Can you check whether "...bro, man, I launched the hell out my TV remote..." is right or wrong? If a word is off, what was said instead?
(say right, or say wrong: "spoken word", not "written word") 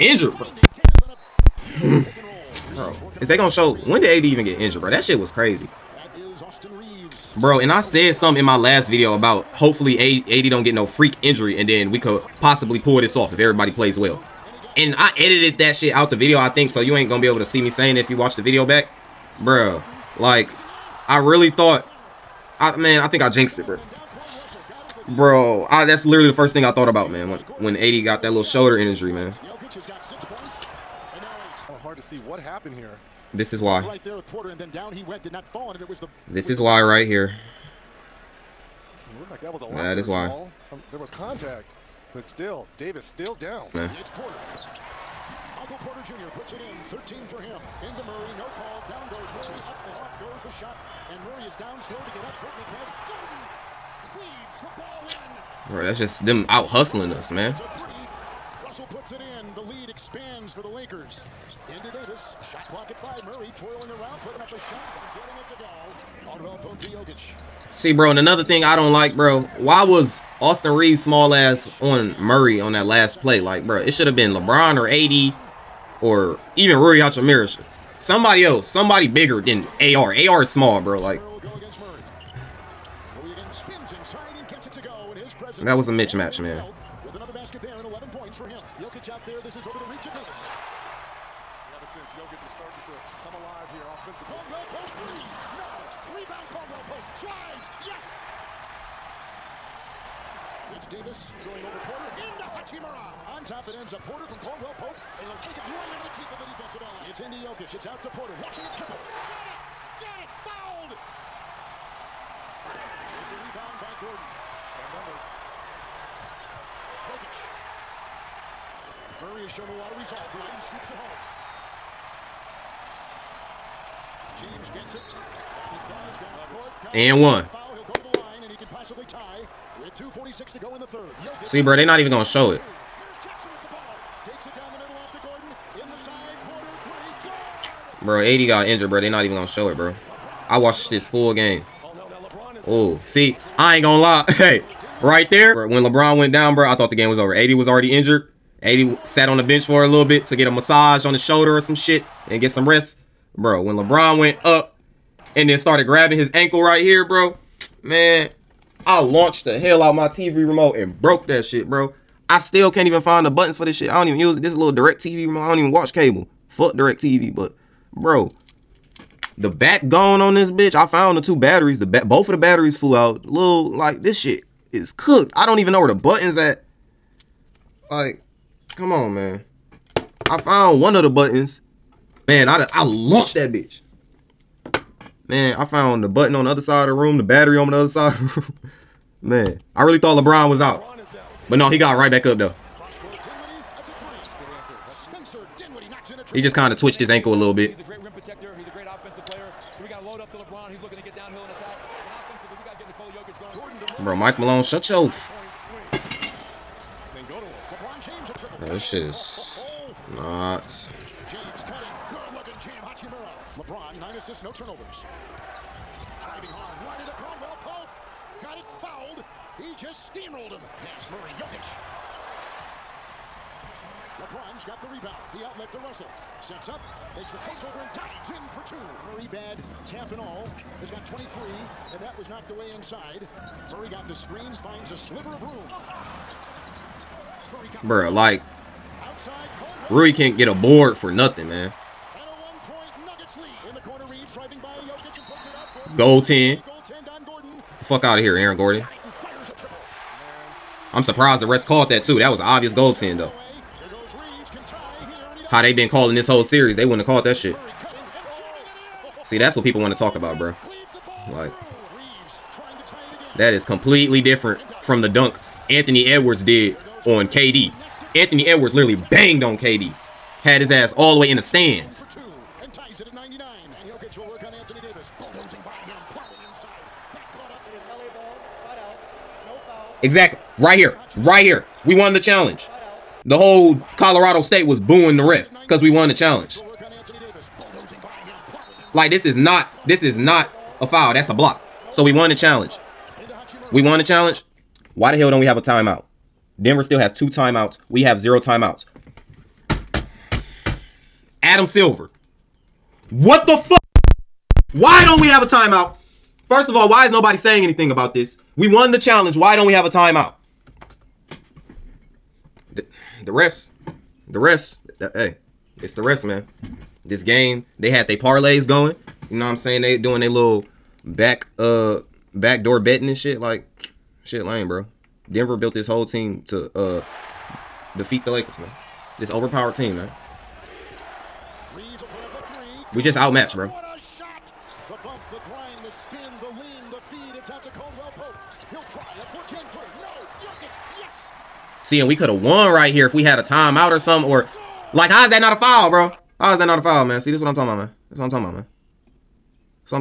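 right.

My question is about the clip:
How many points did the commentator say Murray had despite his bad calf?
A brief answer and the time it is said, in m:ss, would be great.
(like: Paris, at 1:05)
23, at 3:51.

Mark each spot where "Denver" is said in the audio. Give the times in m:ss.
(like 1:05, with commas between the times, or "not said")
4:56, 5:25.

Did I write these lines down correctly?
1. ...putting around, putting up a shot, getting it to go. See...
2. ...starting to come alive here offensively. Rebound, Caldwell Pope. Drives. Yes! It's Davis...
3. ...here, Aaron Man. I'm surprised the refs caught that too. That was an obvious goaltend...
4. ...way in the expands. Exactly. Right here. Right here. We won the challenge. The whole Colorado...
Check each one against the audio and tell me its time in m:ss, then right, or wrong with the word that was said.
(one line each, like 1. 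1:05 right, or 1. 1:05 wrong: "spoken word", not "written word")
1. 1:03 wrong: "twirling", not "putting"
2. 1:32 right
3. 4:08 wrong: "Gordon", not "Man"
4. 4:31 wrong: "stands", not "expands".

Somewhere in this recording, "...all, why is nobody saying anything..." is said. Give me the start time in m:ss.
5:06.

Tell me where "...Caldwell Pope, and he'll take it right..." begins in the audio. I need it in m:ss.
1:44.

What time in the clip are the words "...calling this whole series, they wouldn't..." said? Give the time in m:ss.
4:15.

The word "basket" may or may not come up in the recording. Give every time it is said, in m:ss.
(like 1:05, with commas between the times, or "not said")
1:27.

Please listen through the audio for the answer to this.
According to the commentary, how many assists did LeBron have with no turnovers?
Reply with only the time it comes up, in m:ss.
3:34.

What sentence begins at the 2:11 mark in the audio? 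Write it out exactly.
See, bro, they're not even going to show it.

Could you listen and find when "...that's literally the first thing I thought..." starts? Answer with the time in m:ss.
0:25.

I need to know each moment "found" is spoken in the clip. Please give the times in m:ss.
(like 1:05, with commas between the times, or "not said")
2:50, 3:00, 3:05.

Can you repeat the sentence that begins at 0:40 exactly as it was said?
Um, there was contact, but still, Davis still down.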